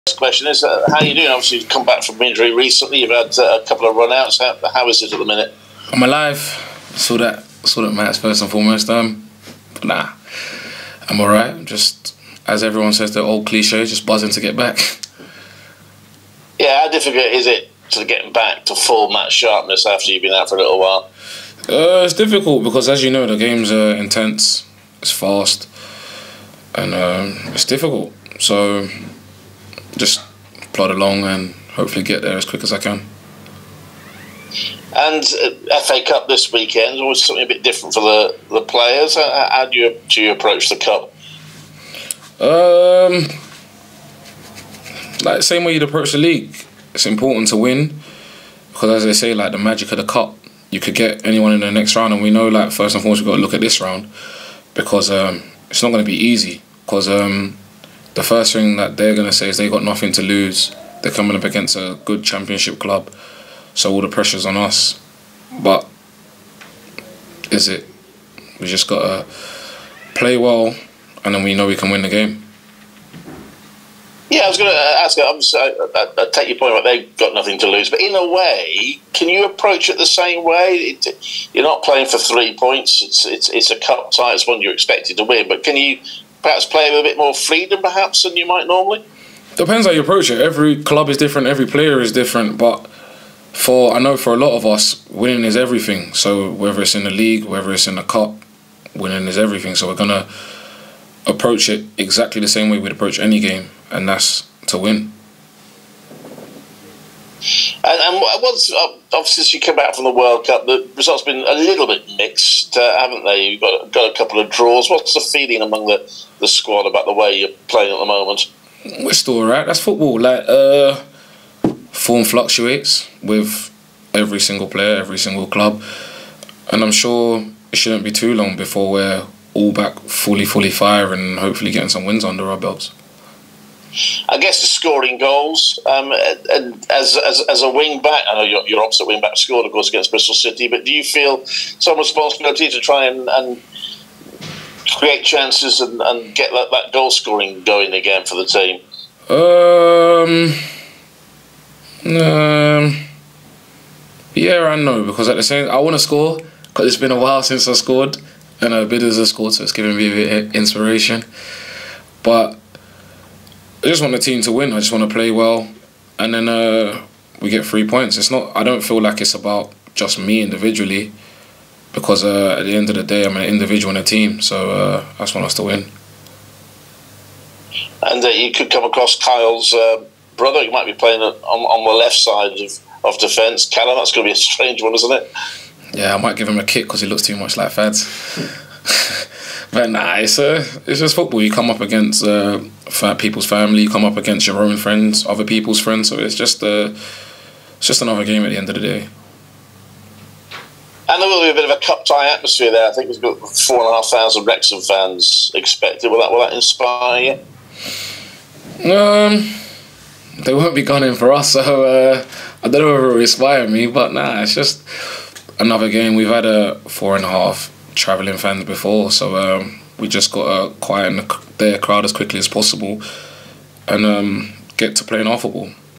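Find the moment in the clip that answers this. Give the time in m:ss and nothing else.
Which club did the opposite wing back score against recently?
2:20.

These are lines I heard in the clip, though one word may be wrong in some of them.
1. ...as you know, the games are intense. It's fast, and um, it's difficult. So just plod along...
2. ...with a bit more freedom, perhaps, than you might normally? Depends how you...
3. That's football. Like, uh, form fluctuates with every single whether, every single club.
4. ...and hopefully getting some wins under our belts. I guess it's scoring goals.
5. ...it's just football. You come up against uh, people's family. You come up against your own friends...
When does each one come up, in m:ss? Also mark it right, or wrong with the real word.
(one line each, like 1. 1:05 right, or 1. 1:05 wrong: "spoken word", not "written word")
1. 0:22 right
2. 1:26 right
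3. 1:59 wrong: "player", not "whether"
4. 2:11 right
5. 3:10 right.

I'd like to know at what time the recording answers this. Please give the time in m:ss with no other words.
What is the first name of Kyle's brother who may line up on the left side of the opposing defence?
3:03.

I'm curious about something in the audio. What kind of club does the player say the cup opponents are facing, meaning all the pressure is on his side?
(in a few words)
A good Championship club.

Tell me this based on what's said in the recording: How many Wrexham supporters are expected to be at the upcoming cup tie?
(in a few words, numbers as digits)
4,500.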